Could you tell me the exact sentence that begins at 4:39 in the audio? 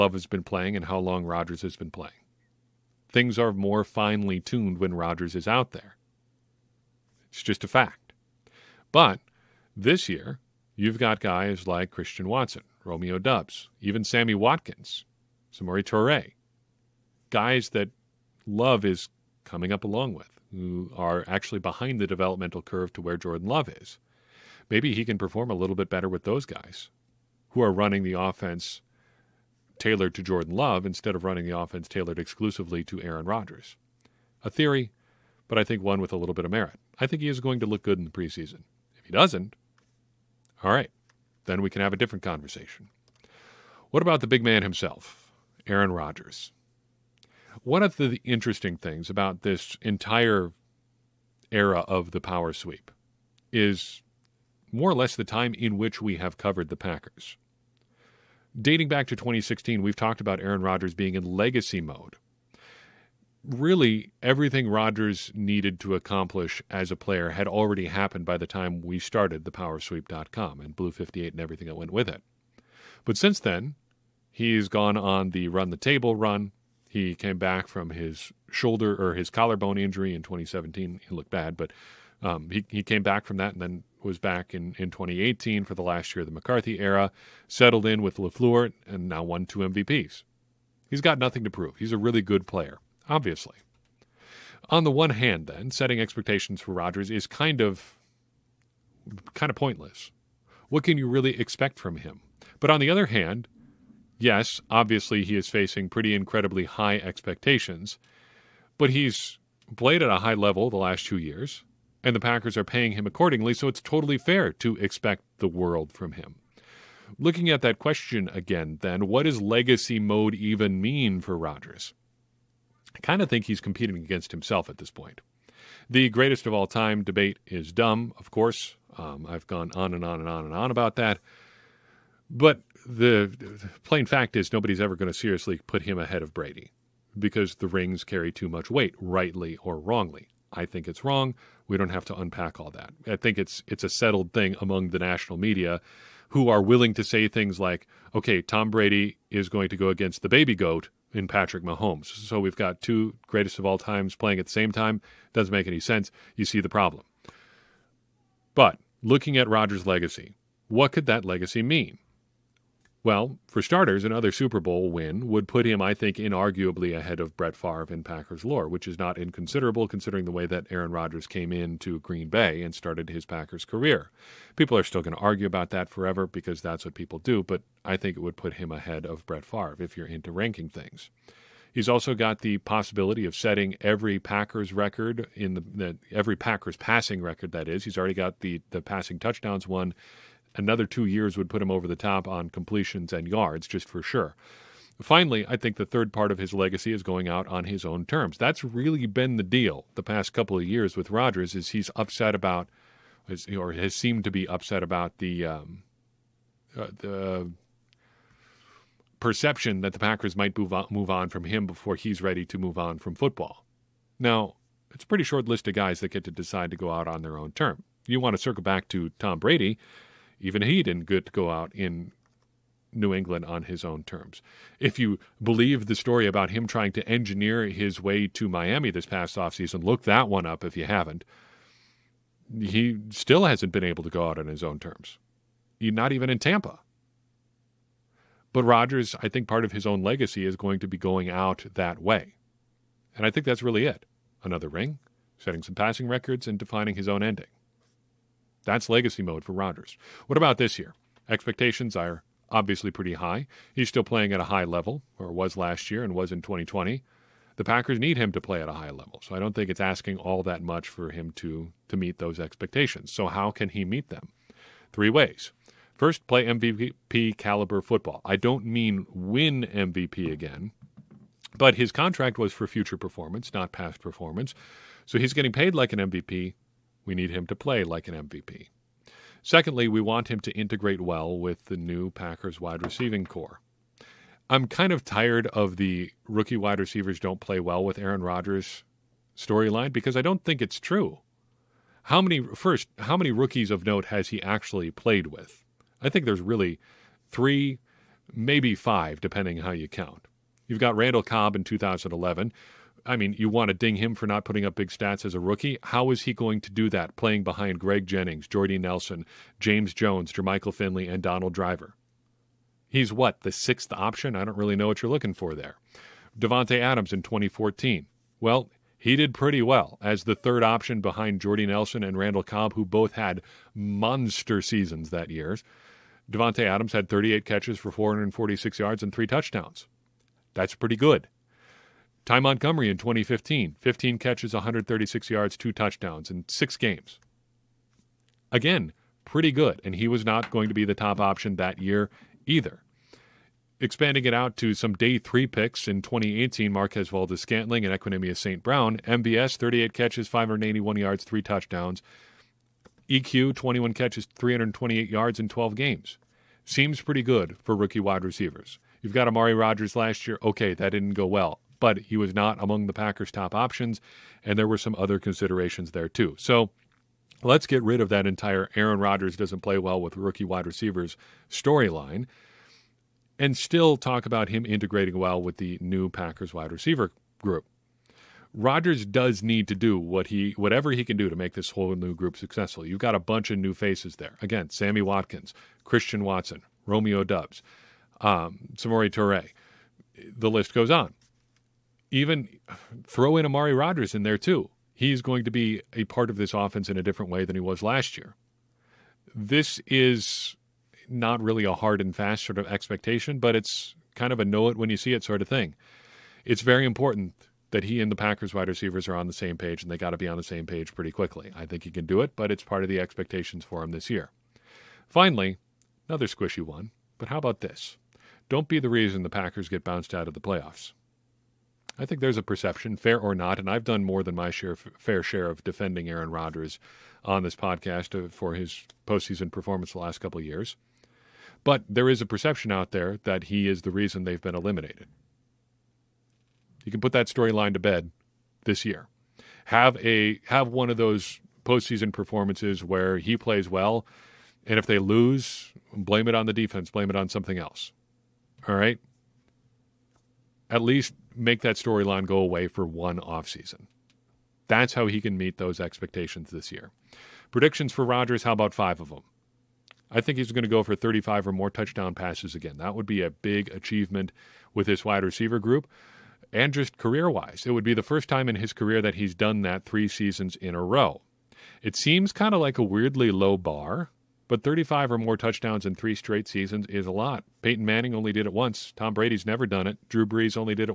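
Secondly, we want him to integrate well with the new Packers wide receiving corps.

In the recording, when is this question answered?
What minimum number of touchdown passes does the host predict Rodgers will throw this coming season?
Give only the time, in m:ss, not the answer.
7:40.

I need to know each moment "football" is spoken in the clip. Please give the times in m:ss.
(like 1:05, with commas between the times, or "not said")
3:33, 4:27.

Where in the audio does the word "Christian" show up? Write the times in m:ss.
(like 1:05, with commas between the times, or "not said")
0:11, 6:25.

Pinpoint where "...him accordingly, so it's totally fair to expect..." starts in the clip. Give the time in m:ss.
1:52.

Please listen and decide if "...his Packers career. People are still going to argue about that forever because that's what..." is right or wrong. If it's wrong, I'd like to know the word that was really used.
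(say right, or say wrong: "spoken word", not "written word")
right.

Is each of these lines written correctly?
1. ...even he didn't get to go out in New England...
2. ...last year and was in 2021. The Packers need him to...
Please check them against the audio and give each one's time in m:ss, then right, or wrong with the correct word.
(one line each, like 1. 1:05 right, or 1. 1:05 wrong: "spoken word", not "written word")
1. 3:40 right
2. 4:15 wrong: "2020", not "2021".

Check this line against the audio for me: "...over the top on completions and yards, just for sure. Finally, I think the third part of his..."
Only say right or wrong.
right.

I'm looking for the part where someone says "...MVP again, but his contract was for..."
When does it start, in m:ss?
4:29.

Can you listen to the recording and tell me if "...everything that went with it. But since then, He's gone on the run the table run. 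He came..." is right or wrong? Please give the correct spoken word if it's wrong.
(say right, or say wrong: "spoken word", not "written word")
right.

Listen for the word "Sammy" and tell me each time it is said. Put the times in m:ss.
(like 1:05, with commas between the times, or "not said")
0:14, 6:24.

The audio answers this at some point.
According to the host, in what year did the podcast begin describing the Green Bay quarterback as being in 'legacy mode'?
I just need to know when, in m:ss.
0:59.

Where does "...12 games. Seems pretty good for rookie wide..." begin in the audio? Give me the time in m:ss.
5:55.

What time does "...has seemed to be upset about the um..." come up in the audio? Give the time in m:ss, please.
3:23.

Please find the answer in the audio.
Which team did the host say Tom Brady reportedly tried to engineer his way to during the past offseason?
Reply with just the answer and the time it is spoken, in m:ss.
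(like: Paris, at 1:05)
Miami, at 3:48.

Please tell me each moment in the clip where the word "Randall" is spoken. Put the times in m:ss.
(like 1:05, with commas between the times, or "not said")
5:00, 5:22.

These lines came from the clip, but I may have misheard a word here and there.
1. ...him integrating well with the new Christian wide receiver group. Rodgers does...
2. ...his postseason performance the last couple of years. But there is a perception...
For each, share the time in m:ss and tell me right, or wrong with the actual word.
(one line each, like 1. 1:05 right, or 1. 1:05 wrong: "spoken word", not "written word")
1. 6:14 wrong: "Packers", not "Christian"
2. 7:08 right.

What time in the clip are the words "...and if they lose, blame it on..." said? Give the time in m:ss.
7:24.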